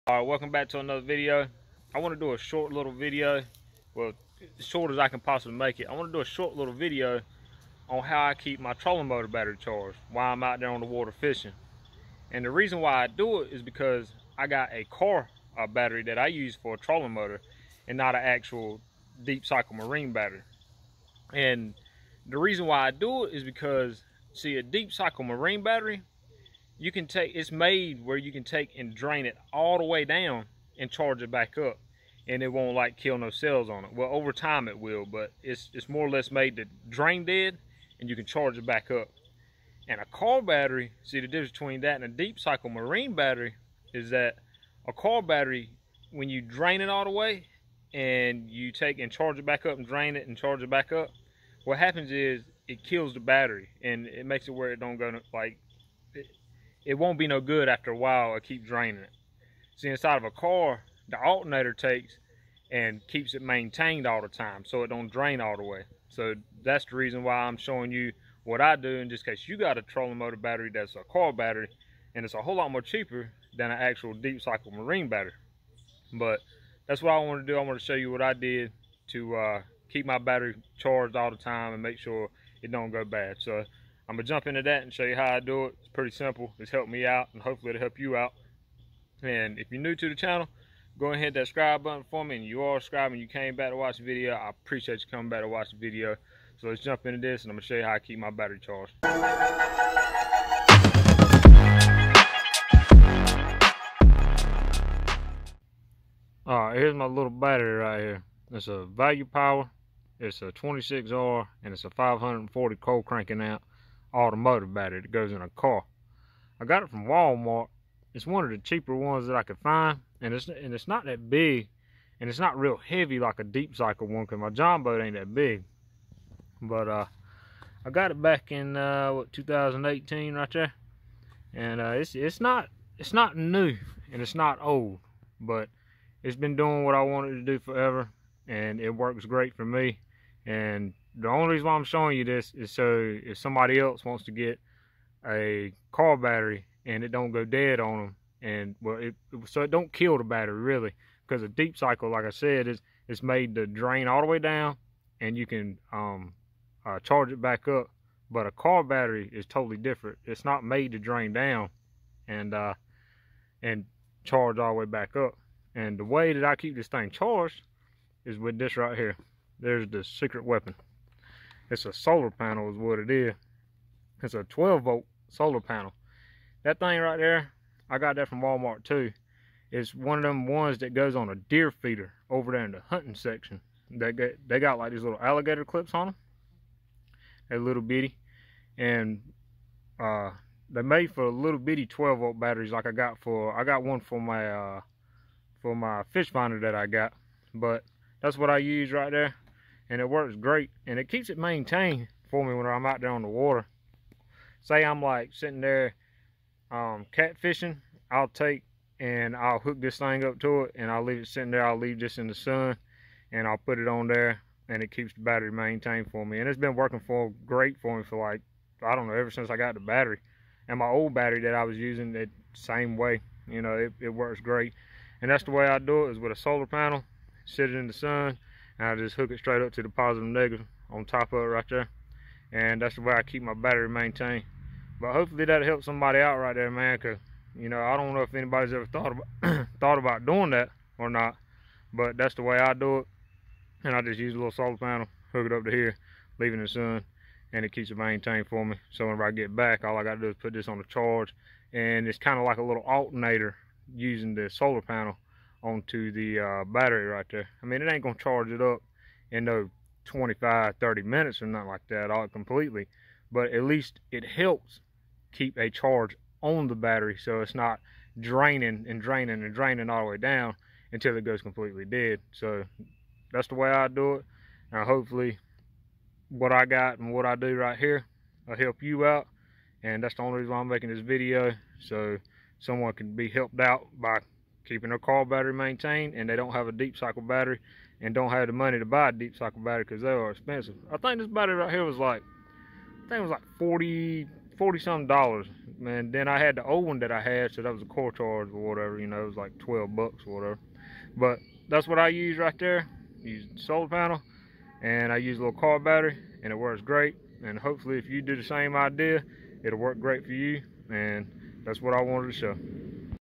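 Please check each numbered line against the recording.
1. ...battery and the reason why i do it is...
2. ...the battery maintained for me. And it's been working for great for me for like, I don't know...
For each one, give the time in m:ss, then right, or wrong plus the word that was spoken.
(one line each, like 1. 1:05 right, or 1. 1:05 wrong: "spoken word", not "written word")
1. 0:20 right
2. 3:35 right.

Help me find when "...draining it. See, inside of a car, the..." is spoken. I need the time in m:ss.
0:58.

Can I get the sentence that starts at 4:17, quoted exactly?
I mean, it ain't going to charge it up in no 25, 30 minutes or nothing like that all completely.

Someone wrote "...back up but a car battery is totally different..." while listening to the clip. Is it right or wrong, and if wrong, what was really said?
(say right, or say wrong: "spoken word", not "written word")
right.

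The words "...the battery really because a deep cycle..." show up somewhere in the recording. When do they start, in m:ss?
2:30.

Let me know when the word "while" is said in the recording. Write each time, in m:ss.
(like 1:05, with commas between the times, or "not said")
0:10, 0:57.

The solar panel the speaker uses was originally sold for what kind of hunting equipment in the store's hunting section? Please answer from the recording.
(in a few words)
Deer feeder.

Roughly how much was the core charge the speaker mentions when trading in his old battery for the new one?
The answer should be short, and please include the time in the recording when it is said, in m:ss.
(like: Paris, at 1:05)
12 bucks, at 4:59.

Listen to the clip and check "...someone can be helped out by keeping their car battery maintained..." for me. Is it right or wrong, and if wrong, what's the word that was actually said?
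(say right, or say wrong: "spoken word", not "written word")
right.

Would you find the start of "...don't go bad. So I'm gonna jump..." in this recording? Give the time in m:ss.
1:22.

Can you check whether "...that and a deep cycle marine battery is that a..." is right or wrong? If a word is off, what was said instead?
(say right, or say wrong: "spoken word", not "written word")
right.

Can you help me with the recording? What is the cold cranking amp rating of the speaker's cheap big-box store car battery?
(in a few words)
540.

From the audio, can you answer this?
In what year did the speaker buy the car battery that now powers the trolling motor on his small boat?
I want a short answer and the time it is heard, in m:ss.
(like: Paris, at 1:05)
2018, at 2:09.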